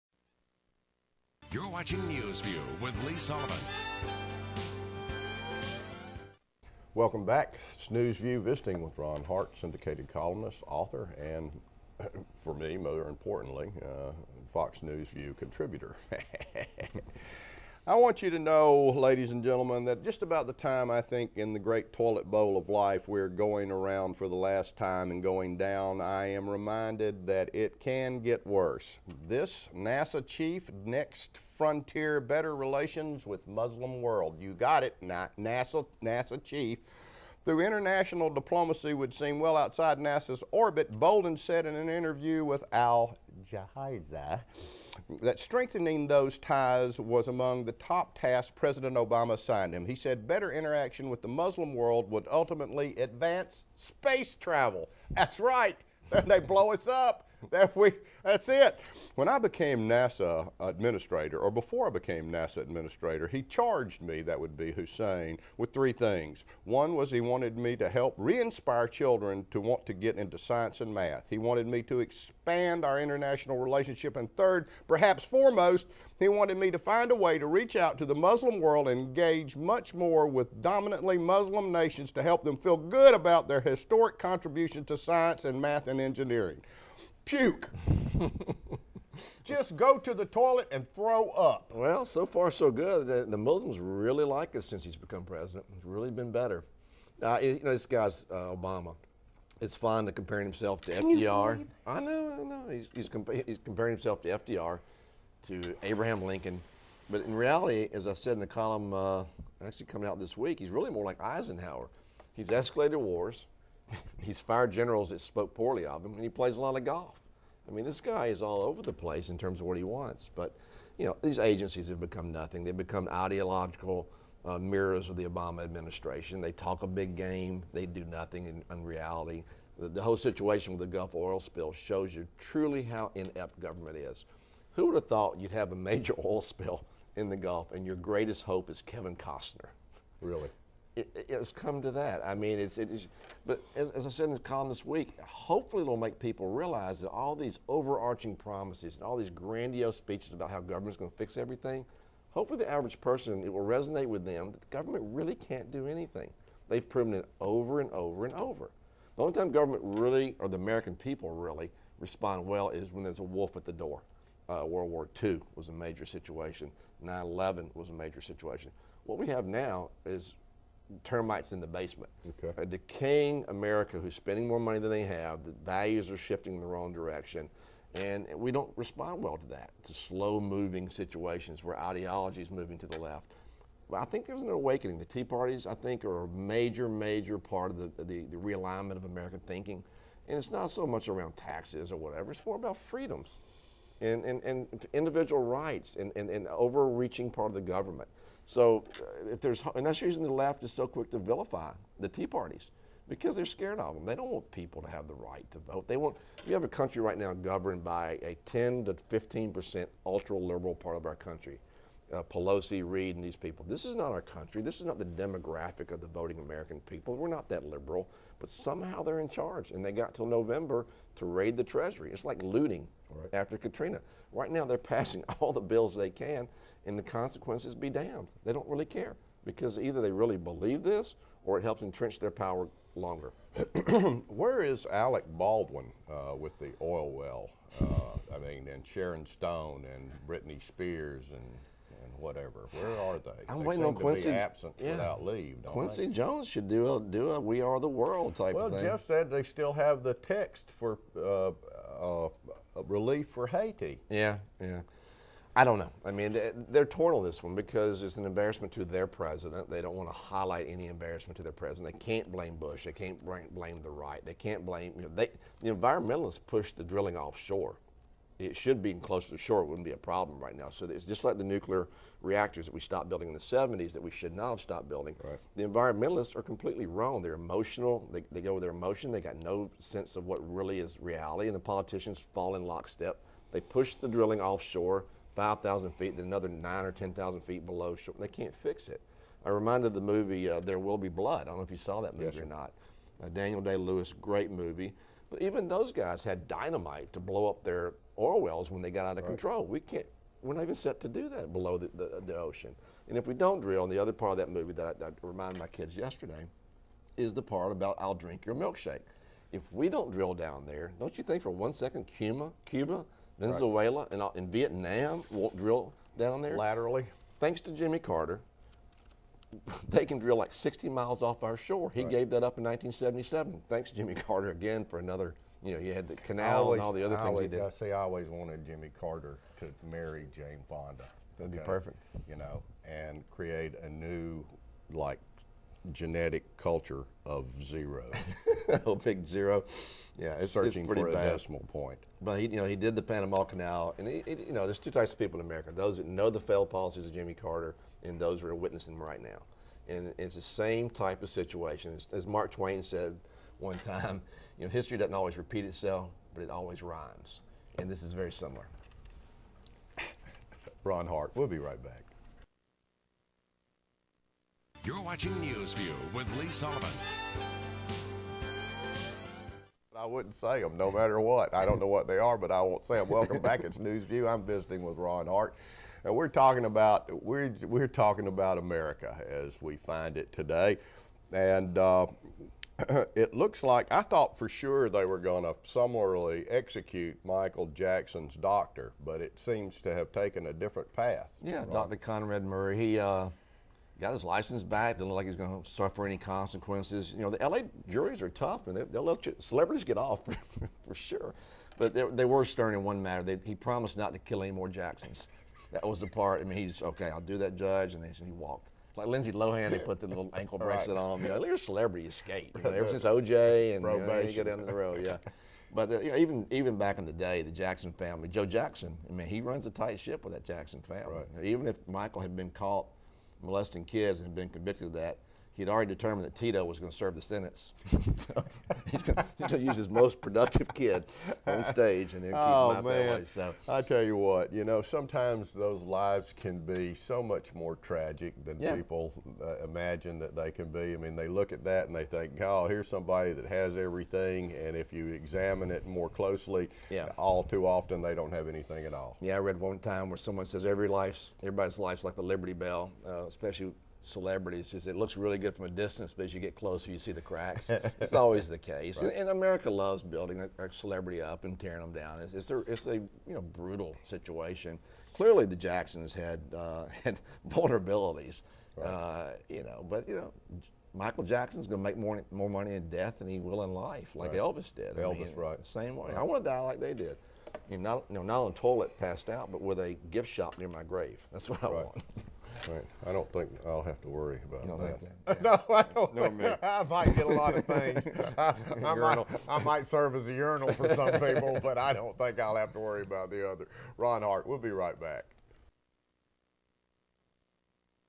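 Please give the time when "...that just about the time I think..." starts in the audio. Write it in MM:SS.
00:19.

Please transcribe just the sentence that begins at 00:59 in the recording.
When I became NASA administrator, or before I became NASA administrator, he charged me, that would be Hussein, with three things.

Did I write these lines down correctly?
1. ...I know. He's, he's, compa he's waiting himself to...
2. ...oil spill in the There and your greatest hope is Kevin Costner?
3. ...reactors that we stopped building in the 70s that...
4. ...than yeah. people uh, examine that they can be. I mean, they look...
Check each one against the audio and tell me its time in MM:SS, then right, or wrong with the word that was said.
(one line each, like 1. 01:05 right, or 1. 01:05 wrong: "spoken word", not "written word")
1. 01:42 wrong: "comparing", not "waiting"
2. 02:16 wrong: "Gulf", not "There"
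3. 04:32 right
4. 07:18 wrong: "imagine", not "examine".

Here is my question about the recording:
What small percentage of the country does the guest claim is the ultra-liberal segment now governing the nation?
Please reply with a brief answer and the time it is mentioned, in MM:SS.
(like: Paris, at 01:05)
10 to 15%, at 03:28.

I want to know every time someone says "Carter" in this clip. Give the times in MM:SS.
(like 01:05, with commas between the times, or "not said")
05:17, 05:24, 05:28, 05:47.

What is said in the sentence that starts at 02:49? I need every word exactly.
What we have now is termites in the basement.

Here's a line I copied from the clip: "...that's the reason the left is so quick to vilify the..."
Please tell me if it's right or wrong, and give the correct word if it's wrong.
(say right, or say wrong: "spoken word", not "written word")
right.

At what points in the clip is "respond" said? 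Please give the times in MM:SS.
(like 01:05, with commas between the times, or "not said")
02:41, 02:58.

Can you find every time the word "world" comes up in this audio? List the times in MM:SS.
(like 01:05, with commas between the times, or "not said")
00:34, 00:51, 01:18, 02:44, 04:07.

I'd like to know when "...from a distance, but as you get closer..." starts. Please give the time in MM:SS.
07:35.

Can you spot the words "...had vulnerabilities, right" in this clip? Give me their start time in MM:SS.
07:47.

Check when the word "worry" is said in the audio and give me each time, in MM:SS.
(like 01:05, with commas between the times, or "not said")
08:04, 08:12.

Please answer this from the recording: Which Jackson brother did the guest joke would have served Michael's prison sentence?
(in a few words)
Tito.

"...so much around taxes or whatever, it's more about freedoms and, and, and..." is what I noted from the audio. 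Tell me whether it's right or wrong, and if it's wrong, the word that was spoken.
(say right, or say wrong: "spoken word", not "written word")
right.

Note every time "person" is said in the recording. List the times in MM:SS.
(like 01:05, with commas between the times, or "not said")
02:32.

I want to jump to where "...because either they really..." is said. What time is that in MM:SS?
03:49.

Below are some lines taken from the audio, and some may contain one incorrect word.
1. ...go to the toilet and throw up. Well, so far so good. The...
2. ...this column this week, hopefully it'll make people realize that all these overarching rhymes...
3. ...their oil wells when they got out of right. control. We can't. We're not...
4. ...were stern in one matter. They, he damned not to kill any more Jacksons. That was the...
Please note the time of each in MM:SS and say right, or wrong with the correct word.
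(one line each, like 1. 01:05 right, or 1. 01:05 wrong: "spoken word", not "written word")
1. 01:29 right
2. 02:24 wrong: "promises", not "rhymes"
3. 04:57 right
4. 06:42 wrong: "promised", not "damned".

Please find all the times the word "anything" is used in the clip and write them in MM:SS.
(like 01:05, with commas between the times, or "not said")
02:35, 07:28.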